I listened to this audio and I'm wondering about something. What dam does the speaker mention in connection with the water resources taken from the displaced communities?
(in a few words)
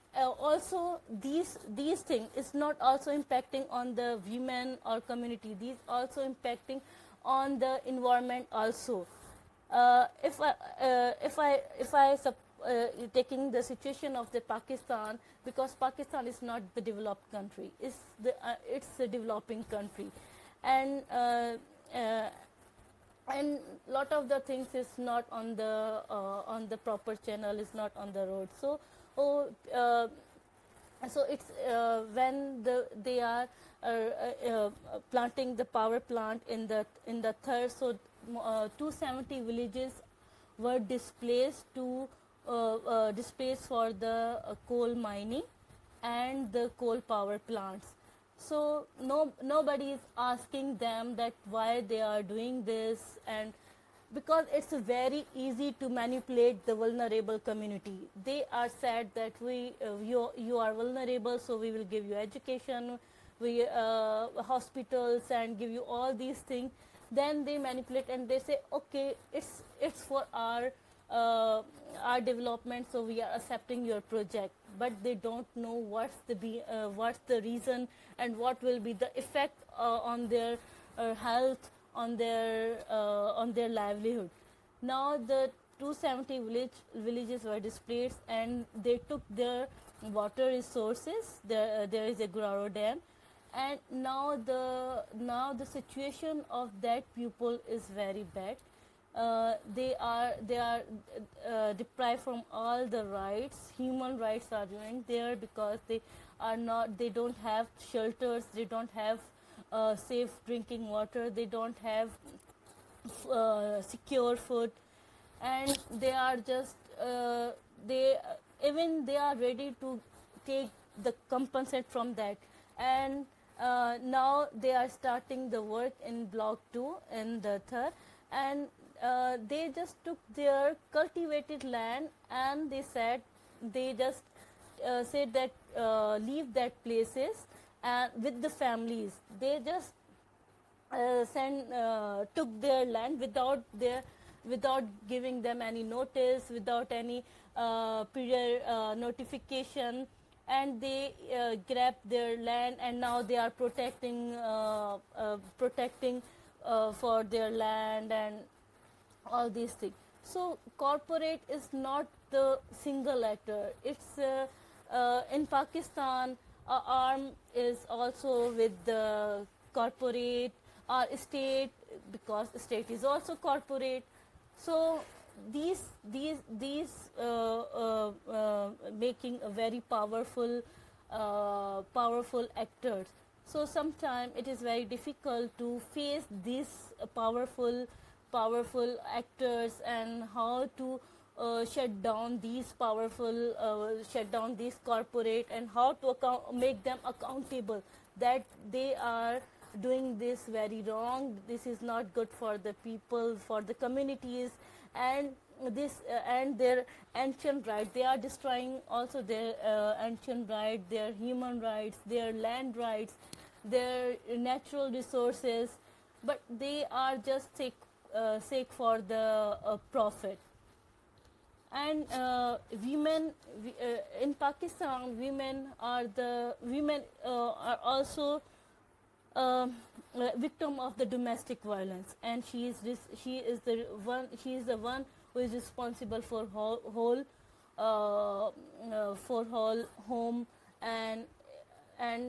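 Guraro dam.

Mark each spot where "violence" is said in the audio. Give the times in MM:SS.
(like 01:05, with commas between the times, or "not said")
03:51.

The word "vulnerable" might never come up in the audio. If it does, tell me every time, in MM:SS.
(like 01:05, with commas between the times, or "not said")
00:56, 01:00.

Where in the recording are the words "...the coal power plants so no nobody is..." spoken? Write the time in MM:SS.
00:46.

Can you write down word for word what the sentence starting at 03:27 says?
They are destroying also their uh, ancient rights, their human rights, their land rights, their natural resources.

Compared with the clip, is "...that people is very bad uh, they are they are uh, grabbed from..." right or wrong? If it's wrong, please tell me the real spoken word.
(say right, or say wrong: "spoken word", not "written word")
wrong: "deprived", not "grabbed".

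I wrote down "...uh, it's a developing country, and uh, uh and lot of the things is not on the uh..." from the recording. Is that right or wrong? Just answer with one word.
right.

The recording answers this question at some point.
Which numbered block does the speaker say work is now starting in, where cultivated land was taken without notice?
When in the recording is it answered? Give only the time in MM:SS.
02:06.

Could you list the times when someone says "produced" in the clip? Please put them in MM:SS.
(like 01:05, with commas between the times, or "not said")
not said.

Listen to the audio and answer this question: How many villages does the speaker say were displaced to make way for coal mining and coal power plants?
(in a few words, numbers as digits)
270.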